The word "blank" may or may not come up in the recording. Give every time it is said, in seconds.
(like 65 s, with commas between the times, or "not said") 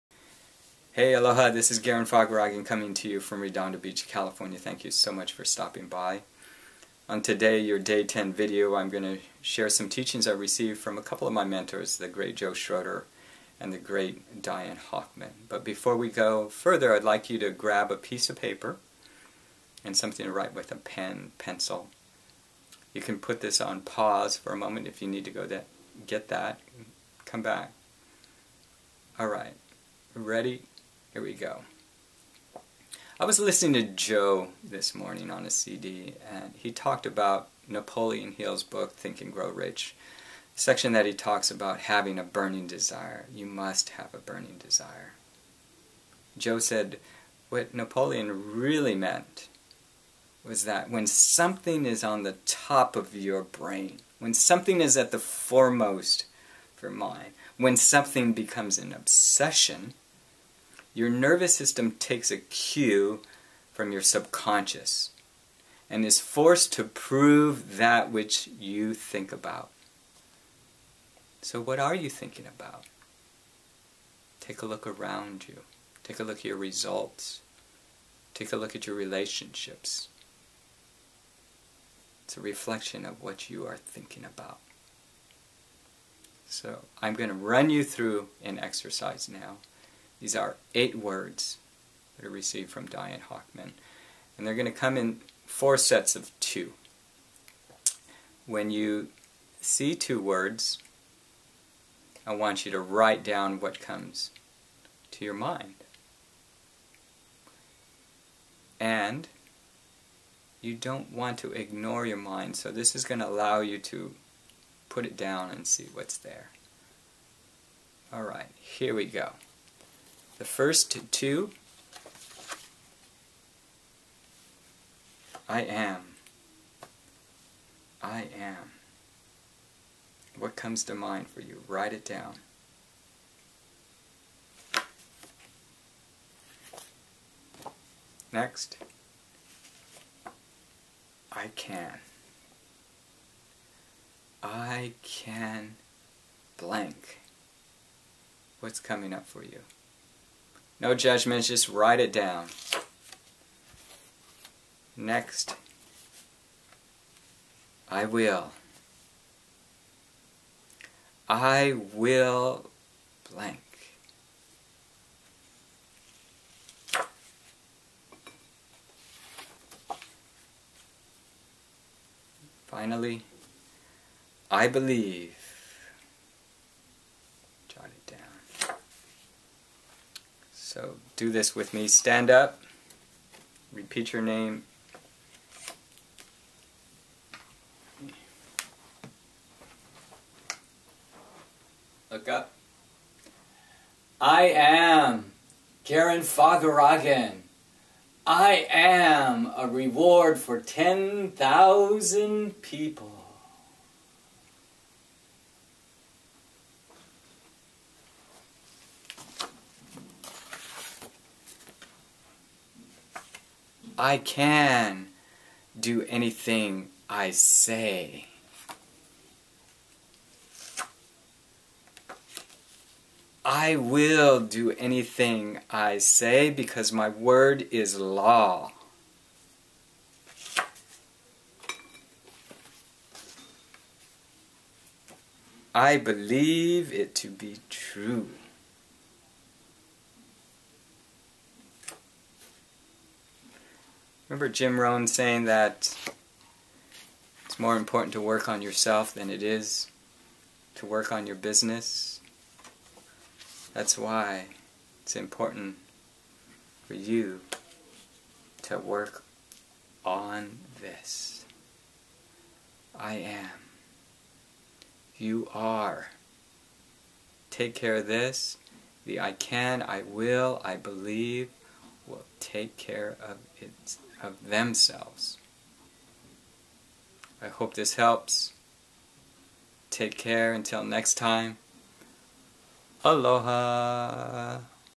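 146 s, 163 s.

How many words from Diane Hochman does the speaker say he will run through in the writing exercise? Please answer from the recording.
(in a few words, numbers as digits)
8.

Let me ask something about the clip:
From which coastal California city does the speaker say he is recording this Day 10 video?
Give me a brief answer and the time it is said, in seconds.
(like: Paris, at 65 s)
Redondo Beach, at 3 s.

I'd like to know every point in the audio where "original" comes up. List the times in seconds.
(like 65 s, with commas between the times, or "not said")
not said.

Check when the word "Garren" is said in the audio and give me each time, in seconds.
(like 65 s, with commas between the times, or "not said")
1 s, 195 s.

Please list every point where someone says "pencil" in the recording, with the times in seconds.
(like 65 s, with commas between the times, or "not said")
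21 s.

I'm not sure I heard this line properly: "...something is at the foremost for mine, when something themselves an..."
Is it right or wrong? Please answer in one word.
wrong.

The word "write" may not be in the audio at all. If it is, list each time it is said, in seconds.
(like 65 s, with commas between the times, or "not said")
20 s, 102 s, 131 s, 151 s.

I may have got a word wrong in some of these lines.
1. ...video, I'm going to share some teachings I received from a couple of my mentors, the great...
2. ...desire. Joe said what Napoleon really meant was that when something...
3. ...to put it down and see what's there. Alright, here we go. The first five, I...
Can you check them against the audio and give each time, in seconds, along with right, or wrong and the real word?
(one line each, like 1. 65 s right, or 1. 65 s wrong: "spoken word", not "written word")
1. 8 s right
2. 44 s right
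3. 113 s wrong: "two", not "five".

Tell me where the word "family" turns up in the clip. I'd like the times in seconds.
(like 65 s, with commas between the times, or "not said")
not said.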